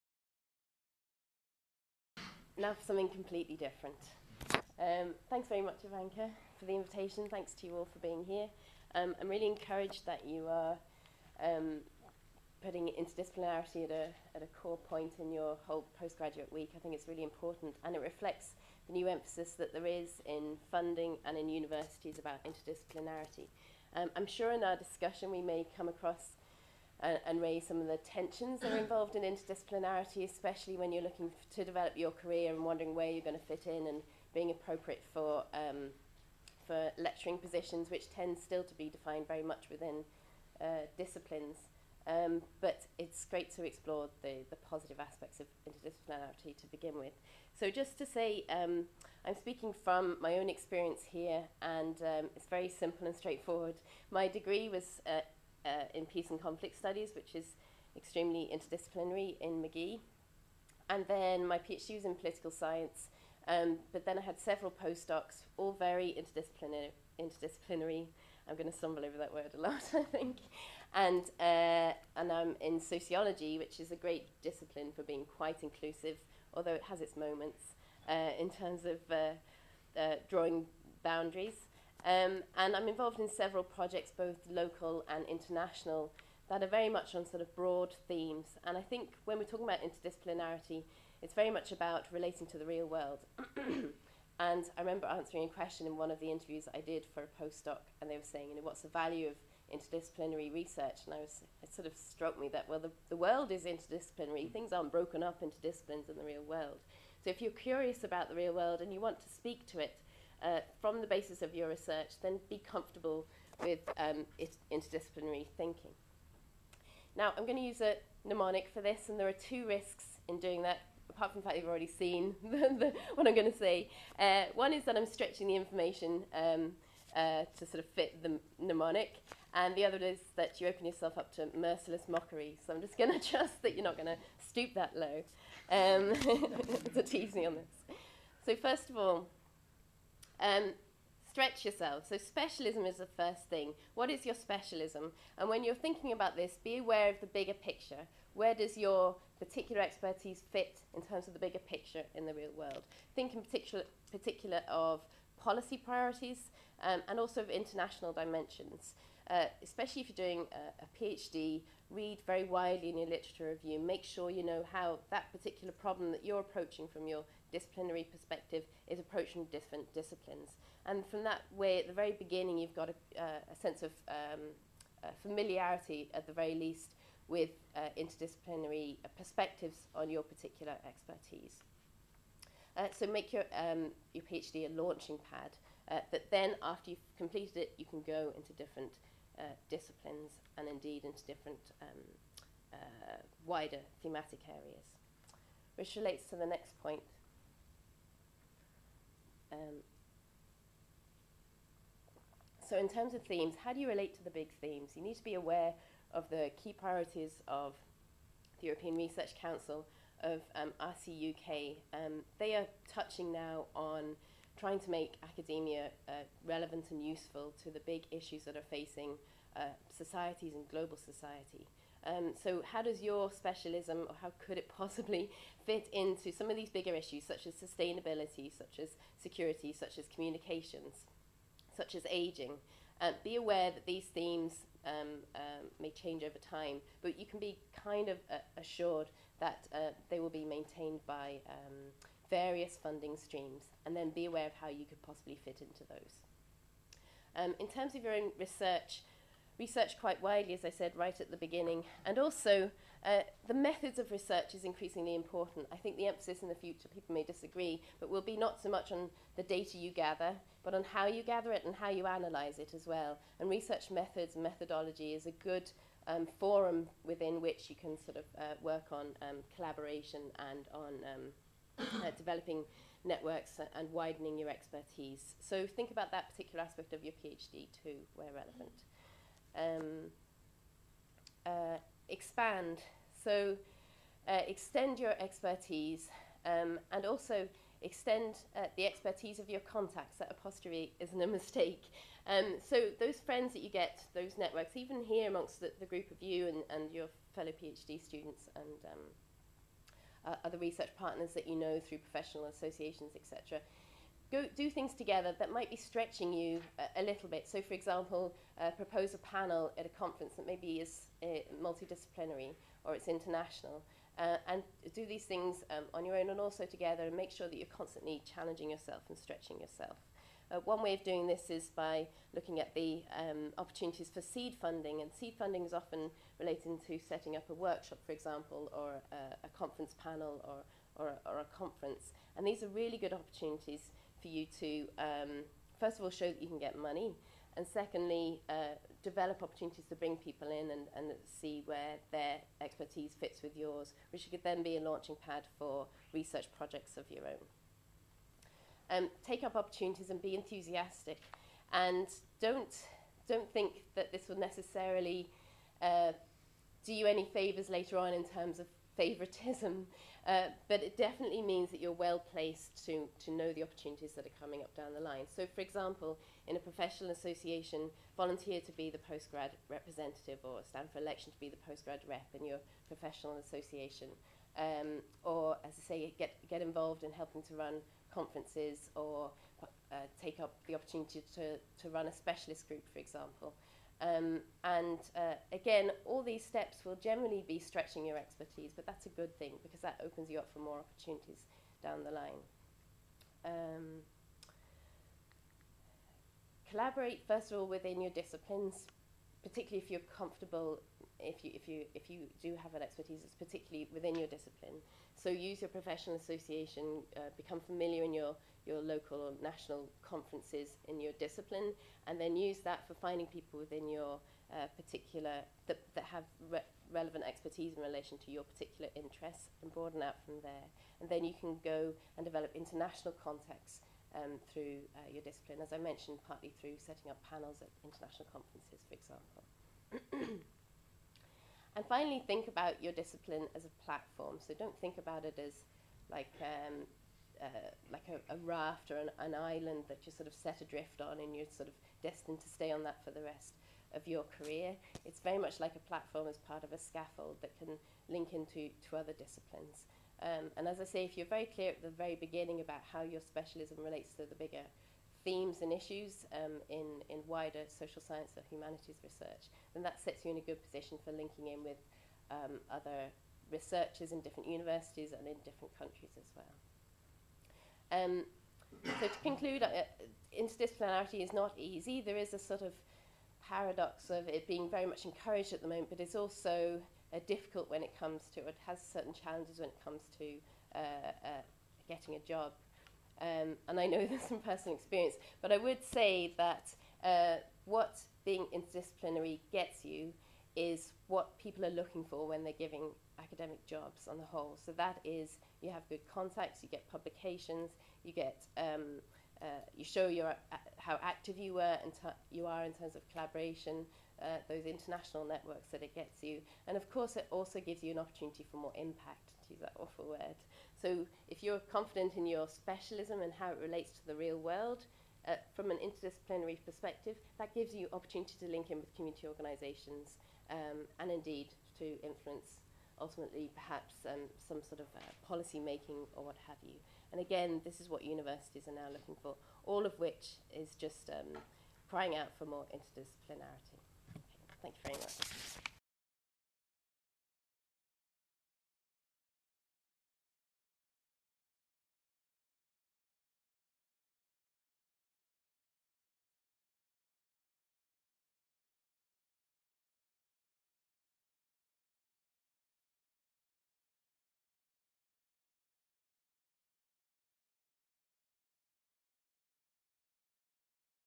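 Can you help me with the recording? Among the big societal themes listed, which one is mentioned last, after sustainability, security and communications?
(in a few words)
Aging.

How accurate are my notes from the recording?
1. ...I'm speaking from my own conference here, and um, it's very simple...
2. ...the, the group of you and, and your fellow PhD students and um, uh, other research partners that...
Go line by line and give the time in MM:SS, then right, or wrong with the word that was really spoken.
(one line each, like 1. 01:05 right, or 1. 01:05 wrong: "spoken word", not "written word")
1. 00:49 wrong: "experience", not "conference"
2. 04:55 right.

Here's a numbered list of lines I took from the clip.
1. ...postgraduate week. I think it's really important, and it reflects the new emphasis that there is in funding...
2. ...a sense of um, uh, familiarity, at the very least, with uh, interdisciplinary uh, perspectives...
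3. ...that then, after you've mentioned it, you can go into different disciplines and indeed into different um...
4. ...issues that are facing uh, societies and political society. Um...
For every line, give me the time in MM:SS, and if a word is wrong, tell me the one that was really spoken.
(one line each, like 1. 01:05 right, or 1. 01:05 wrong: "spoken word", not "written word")
1. 00:15 right
2. 02:53 right
3. 03:06 wrong: "completed", not "mentioned"
4. 03:38 wrong: "global", not "political".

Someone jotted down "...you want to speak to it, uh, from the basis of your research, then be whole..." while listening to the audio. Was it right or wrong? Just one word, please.
wrong.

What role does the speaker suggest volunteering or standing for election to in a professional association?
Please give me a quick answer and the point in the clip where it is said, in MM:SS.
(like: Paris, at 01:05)
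Postgrad representative, at 06:08.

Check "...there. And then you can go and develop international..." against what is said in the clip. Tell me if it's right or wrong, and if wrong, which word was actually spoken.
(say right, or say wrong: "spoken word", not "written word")
right.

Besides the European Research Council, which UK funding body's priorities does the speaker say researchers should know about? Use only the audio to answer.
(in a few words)
RCUK.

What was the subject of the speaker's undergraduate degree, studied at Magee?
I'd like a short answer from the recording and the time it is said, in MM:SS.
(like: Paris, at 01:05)
Peace and Conflict Studies, at 00:56.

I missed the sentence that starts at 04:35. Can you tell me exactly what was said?
So think about that particular aspect of your PhD too, where relevant.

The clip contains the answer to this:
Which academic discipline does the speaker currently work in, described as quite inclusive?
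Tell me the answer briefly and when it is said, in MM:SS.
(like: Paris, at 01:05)
Sociology, at 01:12.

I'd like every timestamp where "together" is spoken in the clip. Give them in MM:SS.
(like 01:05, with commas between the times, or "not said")
05:04, 05:16.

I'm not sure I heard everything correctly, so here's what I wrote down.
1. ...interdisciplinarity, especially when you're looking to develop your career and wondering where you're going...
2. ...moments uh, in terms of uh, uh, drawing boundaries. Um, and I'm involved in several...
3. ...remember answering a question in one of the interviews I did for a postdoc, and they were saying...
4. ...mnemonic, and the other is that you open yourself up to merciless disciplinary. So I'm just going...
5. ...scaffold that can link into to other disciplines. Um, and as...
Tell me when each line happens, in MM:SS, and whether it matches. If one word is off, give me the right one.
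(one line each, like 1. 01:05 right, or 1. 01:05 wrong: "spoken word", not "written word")
1. 00:29 right
2. 01:17 right
3. 01:34 right
4. 02:08 wrong: "mockery", not "disciplinary"
5. 07:26 right.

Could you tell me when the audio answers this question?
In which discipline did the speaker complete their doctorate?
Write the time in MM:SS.
01:02.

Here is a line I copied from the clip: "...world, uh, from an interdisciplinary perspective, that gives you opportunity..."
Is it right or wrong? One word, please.
right.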